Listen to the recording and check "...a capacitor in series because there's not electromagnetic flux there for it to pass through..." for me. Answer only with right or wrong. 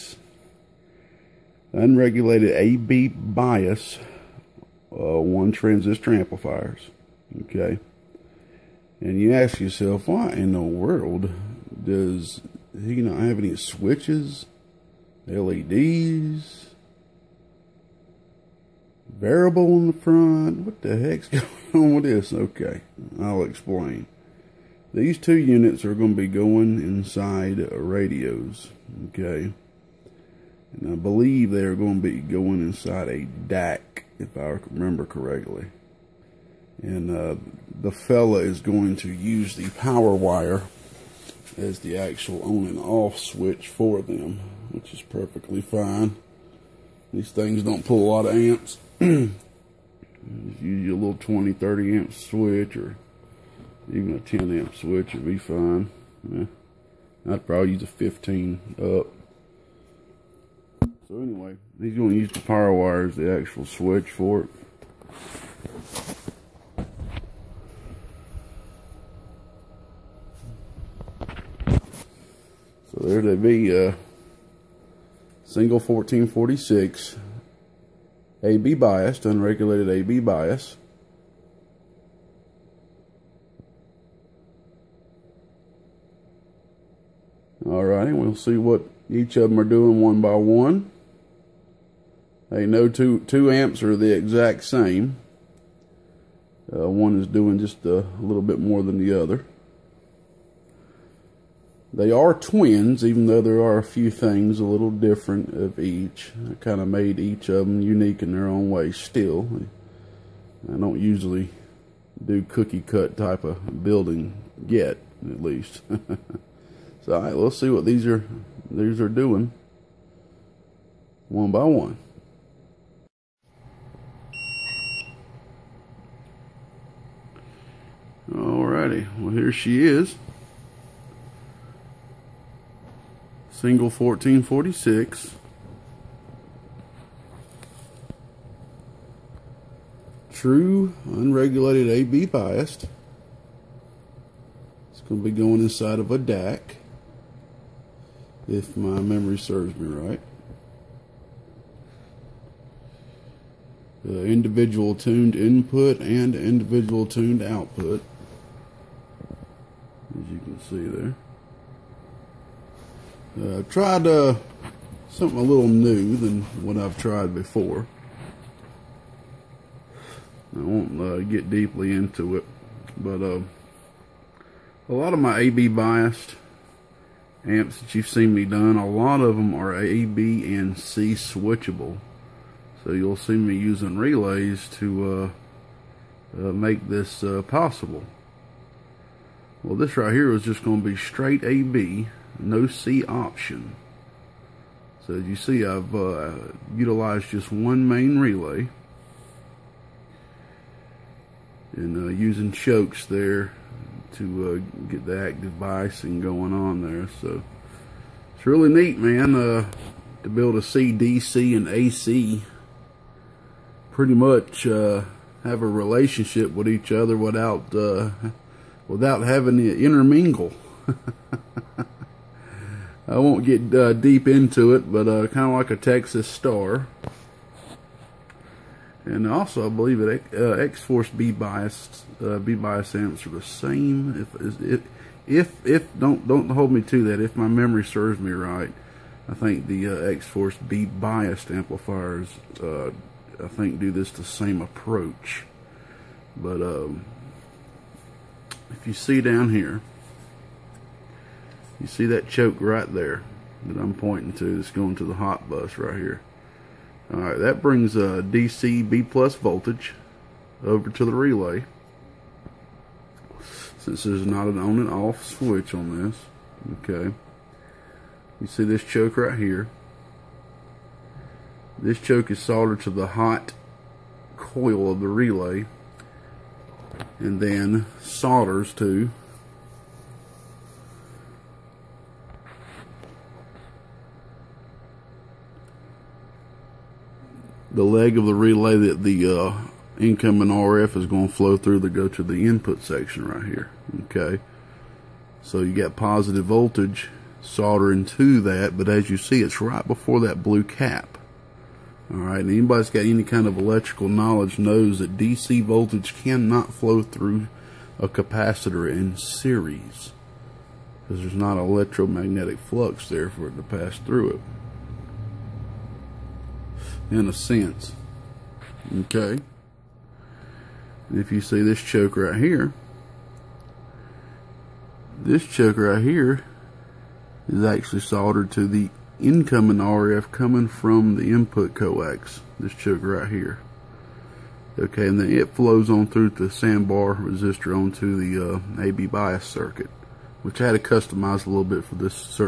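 right.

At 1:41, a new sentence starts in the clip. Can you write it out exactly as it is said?
They are twins, even though there are a few things a little different of each.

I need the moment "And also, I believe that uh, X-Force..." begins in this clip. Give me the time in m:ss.
3:49.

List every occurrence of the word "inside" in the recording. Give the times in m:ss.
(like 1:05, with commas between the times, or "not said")
0:26, 0:32, 2:25.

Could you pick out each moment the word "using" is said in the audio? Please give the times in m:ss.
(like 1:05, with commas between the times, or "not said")
3:03, 3:22.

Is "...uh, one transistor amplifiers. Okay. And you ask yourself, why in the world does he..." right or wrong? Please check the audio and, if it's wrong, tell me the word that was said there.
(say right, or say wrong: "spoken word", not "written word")
right.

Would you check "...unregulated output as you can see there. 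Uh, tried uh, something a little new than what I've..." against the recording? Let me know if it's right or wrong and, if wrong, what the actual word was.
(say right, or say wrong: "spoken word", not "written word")
wrong: "tuned", not "unregulated".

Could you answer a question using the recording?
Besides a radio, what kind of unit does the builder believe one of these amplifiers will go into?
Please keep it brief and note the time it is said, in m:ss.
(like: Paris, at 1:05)
DAK, at 2:26.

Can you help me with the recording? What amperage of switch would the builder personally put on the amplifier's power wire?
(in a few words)
15 amp.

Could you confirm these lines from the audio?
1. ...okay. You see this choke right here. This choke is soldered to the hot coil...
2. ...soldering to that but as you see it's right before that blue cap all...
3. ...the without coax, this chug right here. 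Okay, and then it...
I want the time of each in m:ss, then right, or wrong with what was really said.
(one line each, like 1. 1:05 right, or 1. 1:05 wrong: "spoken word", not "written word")
1. 4:26 right
2. 4:57 right
3. 5:31 wrong: "input", not "without".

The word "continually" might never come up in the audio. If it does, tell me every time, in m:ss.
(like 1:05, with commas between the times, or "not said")
not said.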